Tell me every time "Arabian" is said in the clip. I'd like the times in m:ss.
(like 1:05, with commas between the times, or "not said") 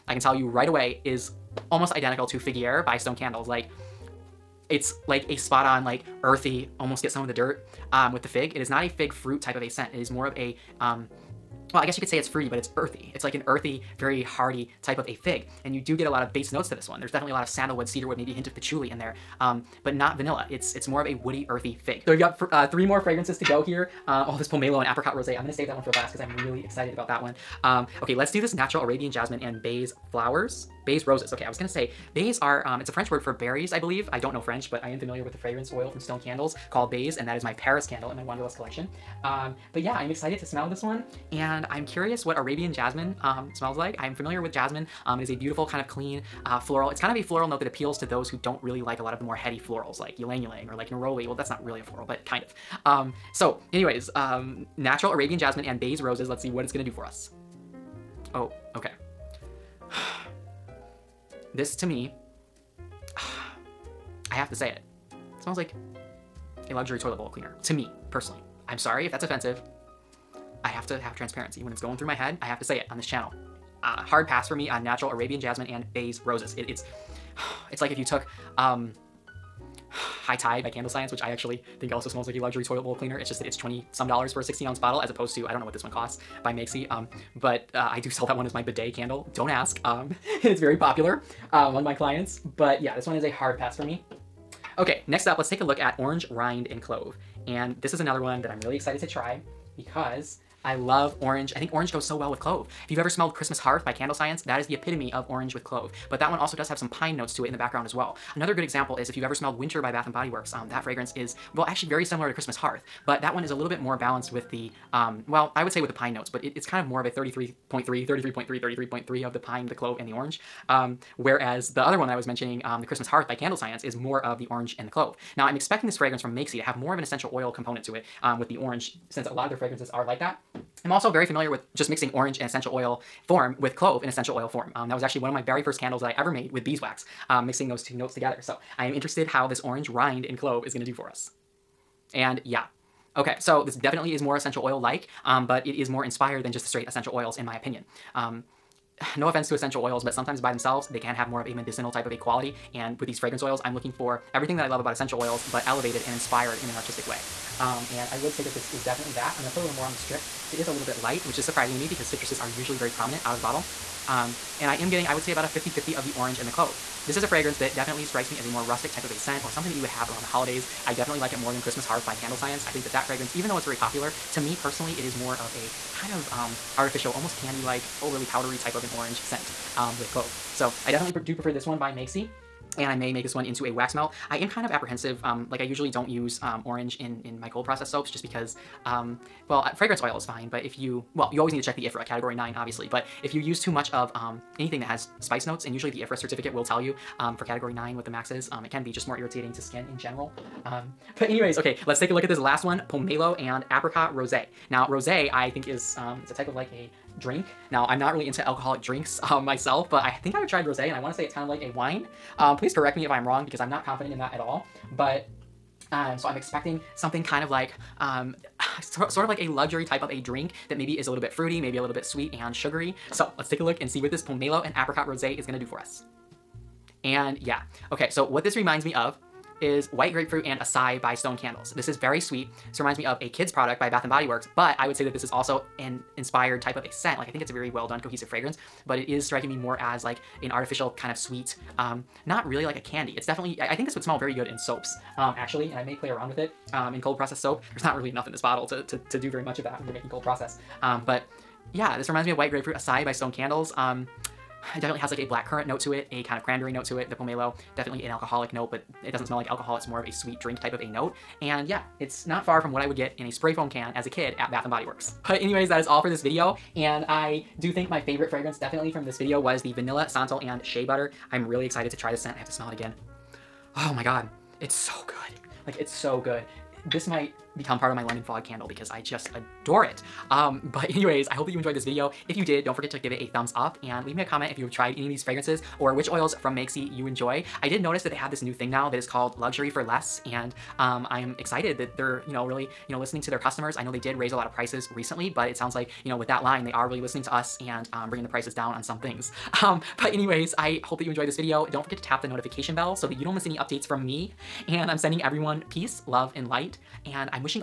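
0:28, 0:42, 0:55, 1:15.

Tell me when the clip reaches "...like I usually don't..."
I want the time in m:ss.
3:05.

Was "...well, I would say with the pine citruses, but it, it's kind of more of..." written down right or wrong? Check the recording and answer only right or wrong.
wrong.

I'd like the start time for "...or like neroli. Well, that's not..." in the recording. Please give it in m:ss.
0:50.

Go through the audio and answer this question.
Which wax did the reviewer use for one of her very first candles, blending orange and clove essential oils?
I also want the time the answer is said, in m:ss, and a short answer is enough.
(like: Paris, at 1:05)
beeswax, at 2:16.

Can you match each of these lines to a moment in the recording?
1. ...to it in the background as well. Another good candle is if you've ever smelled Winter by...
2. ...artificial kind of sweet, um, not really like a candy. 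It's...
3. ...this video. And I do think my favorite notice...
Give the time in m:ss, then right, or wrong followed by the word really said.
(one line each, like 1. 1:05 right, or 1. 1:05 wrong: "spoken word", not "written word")
1. 1:47 wrong: "example", not "candle"
2. 4:00 right
3. 4:26 wrong: "fragrance", not "notice".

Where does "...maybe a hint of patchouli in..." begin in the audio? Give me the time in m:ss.
0:18.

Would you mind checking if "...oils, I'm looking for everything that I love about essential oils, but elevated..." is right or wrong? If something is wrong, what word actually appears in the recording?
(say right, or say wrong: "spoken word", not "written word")
right.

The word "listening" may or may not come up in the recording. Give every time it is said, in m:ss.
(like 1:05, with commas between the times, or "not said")
4:52, 4:57.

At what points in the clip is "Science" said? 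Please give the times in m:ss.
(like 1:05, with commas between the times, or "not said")
1:20, 1:44, 2:03, 2:52.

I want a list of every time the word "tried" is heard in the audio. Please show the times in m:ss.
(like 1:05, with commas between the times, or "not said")
3:30, 4:44.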